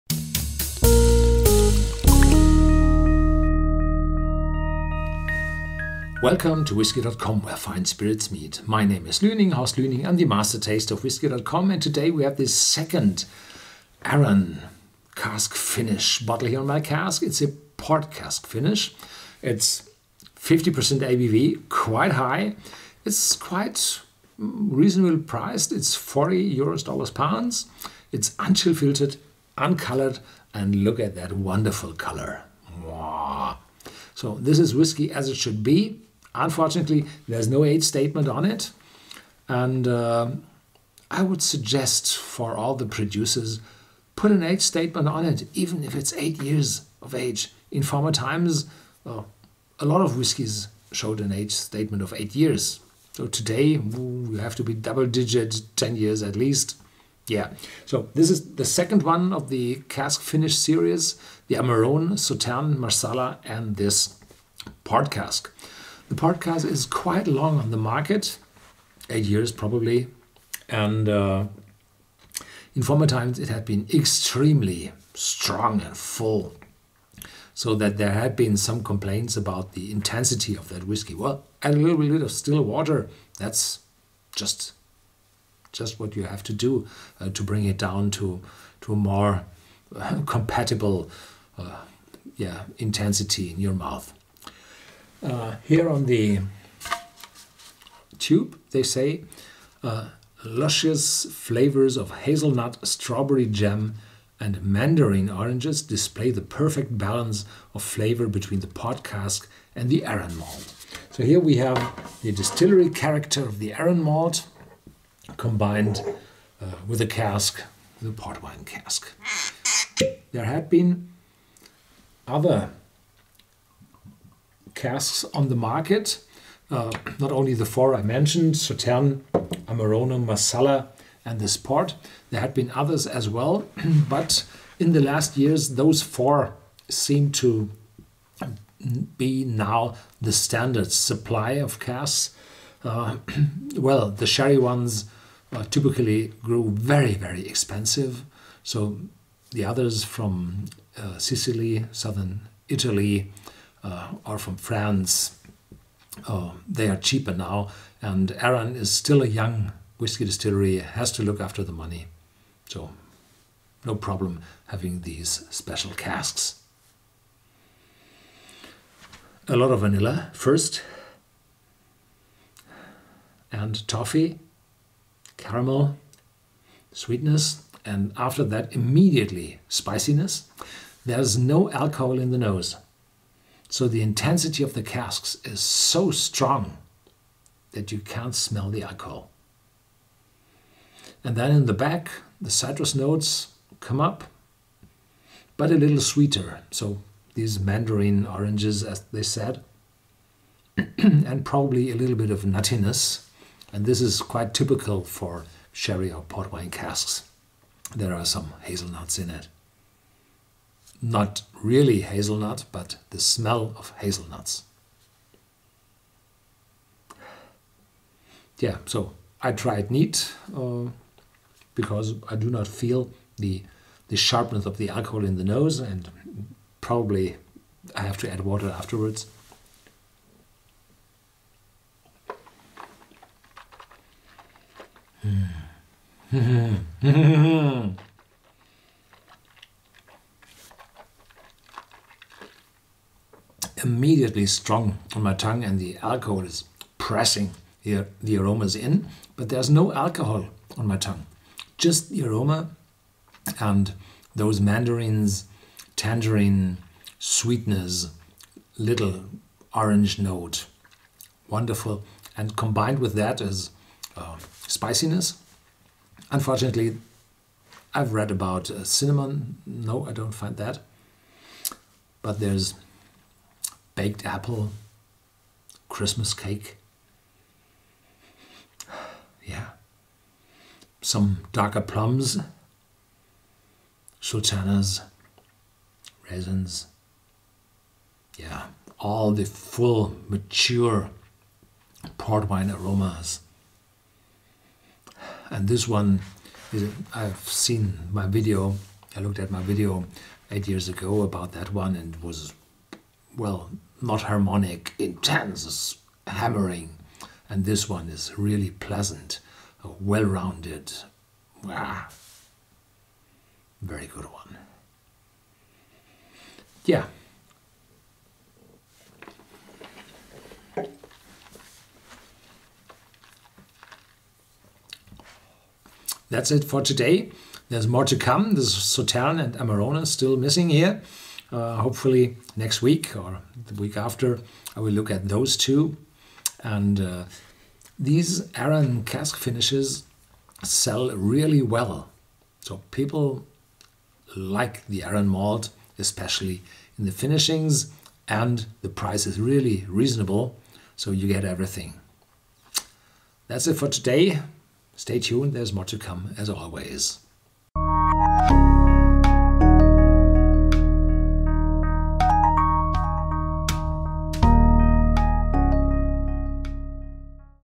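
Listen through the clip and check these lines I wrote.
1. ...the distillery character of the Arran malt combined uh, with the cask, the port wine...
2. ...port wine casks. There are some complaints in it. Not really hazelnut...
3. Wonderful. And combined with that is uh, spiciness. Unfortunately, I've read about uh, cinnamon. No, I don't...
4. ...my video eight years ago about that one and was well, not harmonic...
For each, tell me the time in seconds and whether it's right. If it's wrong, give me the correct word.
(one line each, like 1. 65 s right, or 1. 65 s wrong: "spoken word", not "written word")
1. 112 s right
2. 206 s wrong: "hazelnuts", not "complaints"
3. 261 s right
4. 299 s right.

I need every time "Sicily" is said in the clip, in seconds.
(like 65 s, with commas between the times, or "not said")
151 s.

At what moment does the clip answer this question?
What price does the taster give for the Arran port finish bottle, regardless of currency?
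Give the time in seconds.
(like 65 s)
25 s.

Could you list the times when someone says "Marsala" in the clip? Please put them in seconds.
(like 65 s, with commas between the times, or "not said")
62 s, 130 s.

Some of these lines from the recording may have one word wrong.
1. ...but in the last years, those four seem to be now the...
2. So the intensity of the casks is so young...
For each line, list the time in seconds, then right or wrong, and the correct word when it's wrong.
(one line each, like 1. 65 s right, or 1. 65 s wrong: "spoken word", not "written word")
1. 134 s right
2. 183 s wrong: "strong", not "young".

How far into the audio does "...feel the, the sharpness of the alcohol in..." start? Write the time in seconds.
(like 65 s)
222 s.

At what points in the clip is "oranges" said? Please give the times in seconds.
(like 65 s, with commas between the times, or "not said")
105 s, 198 s, 259 s.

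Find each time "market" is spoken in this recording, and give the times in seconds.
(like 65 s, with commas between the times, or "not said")
67 s, 125 s.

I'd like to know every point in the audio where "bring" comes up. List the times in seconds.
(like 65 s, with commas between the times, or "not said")
87 s.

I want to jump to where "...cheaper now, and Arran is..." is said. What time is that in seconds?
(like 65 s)
156 s.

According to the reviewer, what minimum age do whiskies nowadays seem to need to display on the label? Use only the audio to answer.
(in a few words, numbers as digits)
10 years.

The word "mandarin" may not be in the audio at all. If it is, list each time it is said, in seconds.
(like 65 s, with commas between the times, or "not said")
104 s, 197 s, 254 s.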